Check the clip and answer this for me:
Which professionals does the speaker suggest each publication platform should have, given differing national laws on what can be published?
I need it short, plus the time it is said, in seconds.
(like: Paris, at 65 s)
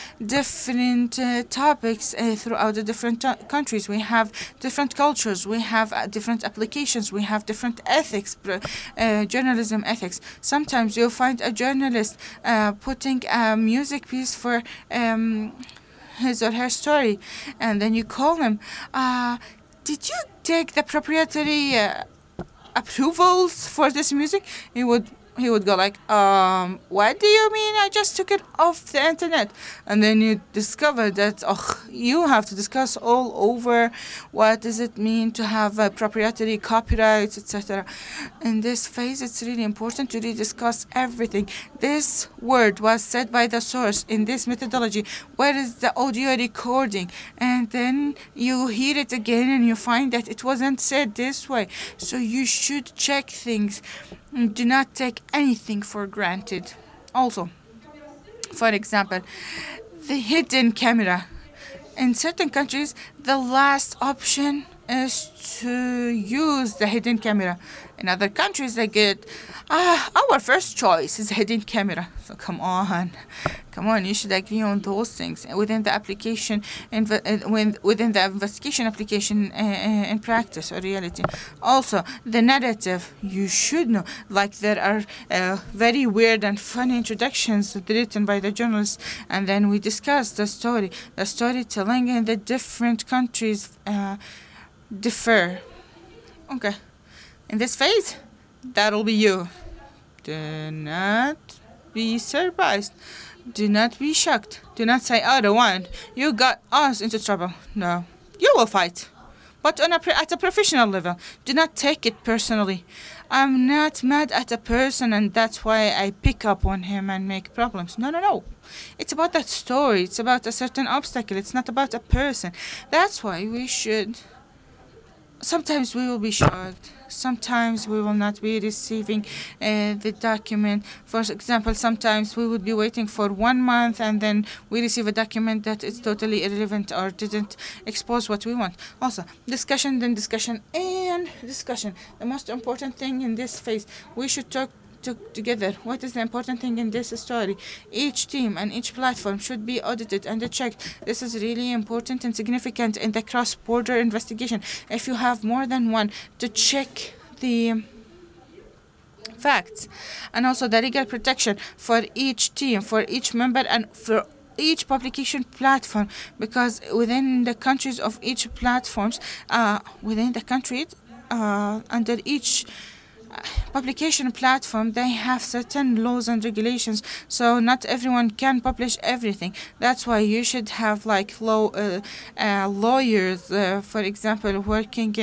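Lawyers, at 182 s.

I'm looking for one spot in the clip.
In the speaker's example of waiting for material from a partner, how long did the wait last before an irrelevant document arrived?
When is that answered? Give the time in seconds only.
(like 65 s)
133 s.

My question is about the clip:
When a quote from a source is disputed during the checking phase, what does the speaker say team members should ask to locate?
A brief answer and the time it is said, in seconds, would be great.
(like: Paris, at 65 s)
The audio recording, at 45 s.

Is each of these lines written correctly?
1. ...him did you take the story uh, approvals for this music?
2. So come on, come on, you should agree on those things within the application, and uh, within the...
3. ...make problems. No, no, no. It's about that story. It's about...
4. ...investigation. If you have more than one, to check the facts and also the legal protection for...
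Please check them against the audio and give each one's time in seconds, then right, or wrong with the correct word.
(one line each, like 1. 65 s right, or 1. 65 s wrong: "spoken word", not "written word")
1. 18 s wrong: "proprietary", not "story"
2. 72 s right
3. 117 s right
4. 153 s right.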